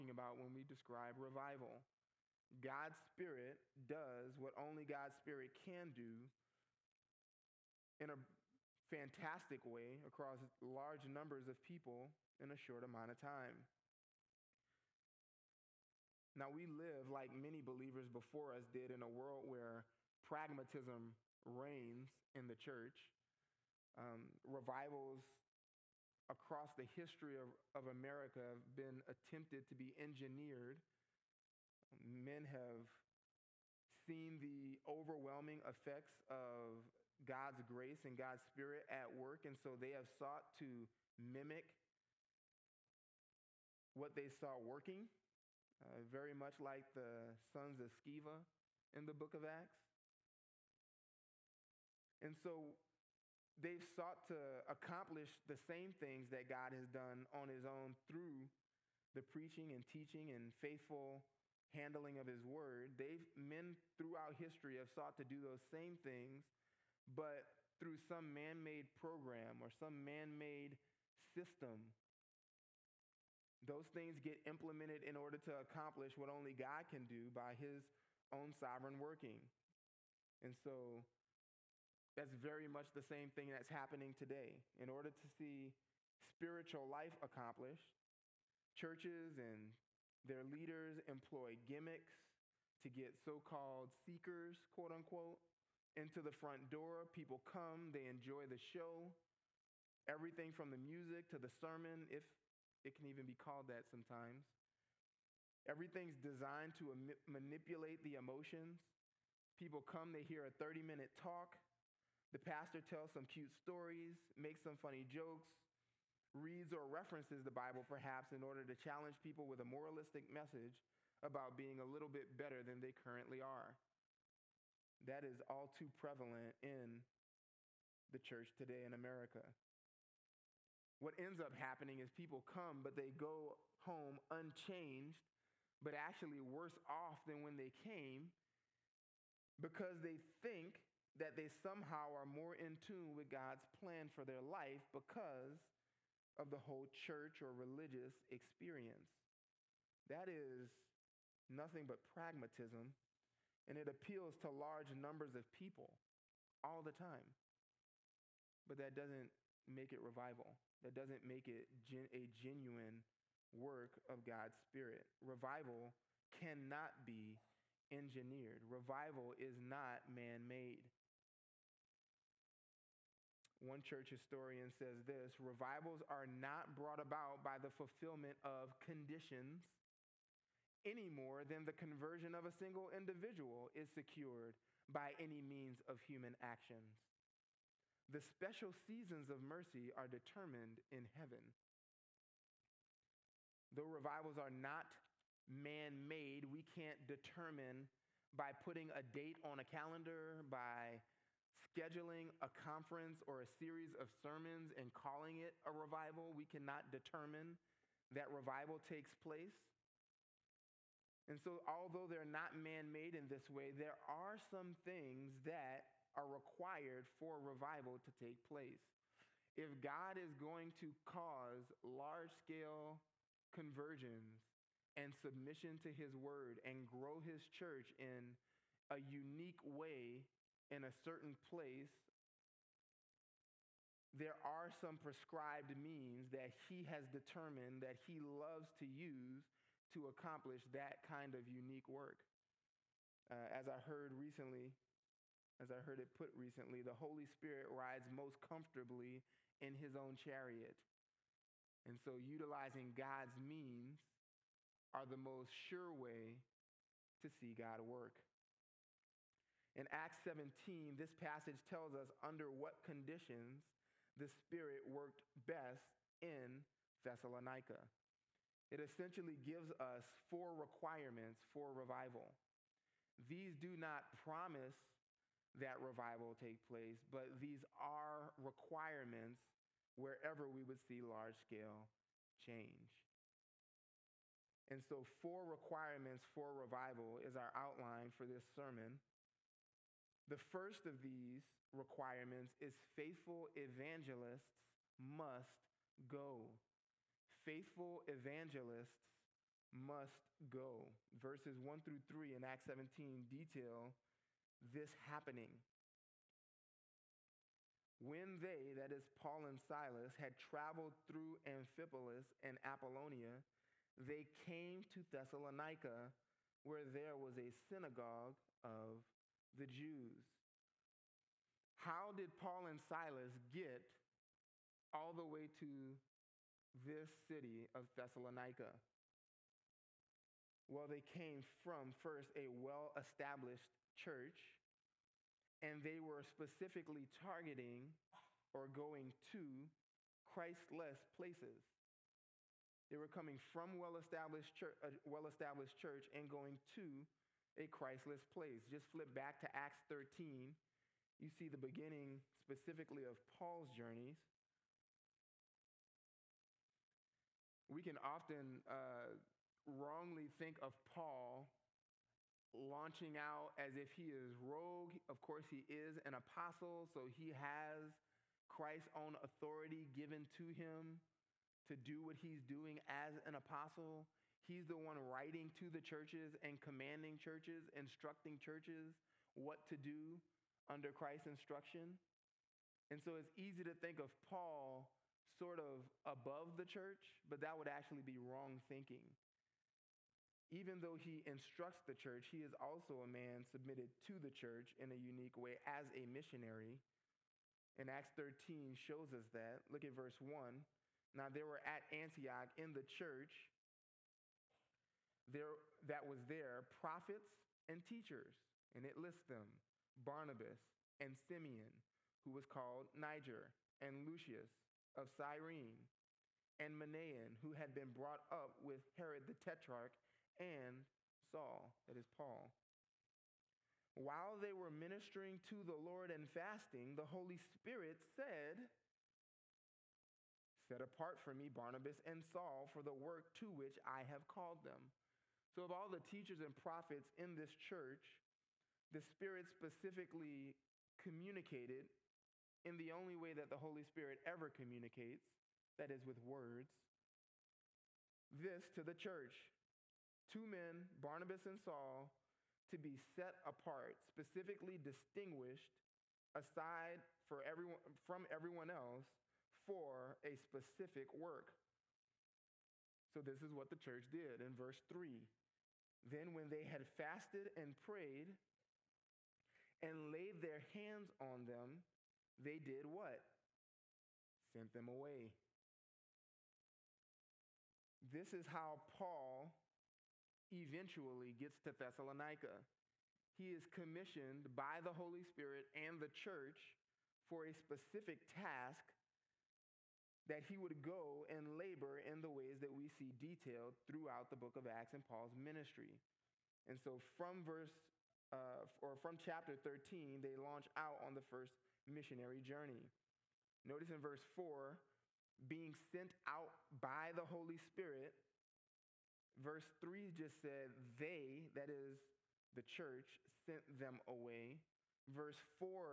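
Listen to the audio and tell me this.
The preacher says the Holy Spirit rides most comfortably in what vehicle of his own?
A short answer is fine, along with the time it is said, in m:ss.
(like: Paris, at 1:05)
His own chariot, at 4:09.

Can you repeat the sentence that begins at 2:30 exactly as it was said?
That is nothing but pragmatism and it appeals to large numbers of people all the time.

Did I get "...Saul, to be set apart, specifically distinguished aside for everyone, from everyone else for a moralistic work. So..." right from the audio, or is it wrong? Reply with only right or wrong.
wrong.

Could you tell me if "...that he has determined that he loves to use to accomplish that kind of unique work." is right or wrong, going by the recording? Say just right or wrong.
right.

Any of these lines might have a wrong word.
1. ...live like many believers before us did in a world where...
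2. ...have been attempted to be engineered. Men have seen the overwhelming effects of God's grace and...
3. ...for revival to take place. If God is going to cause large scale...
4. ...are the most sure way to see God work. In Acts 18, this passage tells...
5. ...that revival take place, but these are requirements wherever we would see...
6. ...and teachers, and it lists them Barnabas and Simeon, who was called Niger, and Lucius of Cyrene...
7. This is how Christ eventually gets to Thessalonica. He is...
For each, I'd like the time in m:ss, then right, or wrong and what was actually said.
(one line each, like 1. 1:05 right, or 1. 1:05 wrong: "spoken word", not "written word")
1. 0:16 right
2. 0:28 right
3. 3:37 right
4. 4:14 wrong: "17", not "18"
5. 4:35 right
6. 6:47 right
7. 7:58 wrong: "Paul", not "Christ".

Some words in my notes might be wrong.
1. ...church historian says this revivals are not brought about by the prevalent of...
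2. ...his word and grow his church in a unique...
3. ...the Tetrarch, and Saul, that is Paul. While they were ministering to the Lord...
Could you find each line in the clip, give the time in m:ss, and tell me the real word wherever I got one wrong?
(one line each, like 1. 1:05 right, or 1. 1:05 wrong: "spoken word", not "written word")
1. 2:53 wrong: "fulfillment", not "prevalent"
2. 3:45 right
3. 6:59 right.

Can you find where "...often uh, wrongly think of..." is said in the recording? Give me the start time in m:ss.
5:57.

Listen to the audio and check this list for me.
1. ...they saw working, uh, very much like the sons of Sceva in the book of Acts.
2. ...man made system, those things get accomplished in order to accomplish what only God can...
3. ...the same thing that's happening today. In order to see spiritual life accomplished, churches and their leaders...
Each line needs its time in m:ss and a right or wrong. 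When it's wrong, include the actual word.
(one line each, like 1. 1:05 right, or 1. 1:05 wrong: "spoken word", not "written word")
1. 0:44 right
2. 1:10 wrong: "implemented", not "accomplished"
3. 1:22 right.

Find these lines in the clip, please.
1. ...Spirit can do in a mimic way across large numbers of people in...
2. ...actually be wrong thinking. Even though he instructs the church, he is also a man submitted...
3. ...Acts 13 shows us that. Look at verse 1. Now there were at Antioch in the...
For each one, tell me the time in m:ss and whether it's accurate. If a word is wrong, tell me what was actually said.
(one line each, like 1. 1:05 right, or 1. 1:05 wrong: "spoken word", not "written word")
1. 0:05 wrong: "fantastic", not "mimic"
2. 6:27 right
3. 6:37 right.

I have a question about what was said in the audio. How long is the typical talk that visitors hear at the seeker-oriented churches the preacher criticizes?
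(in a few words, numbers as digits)
30 minute.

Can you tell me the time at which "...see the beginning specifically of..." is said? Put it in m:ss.
5:51.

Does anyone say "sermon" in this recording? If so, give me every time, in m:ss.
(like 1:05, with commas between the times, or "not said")
1:41, 3:24, 4:48.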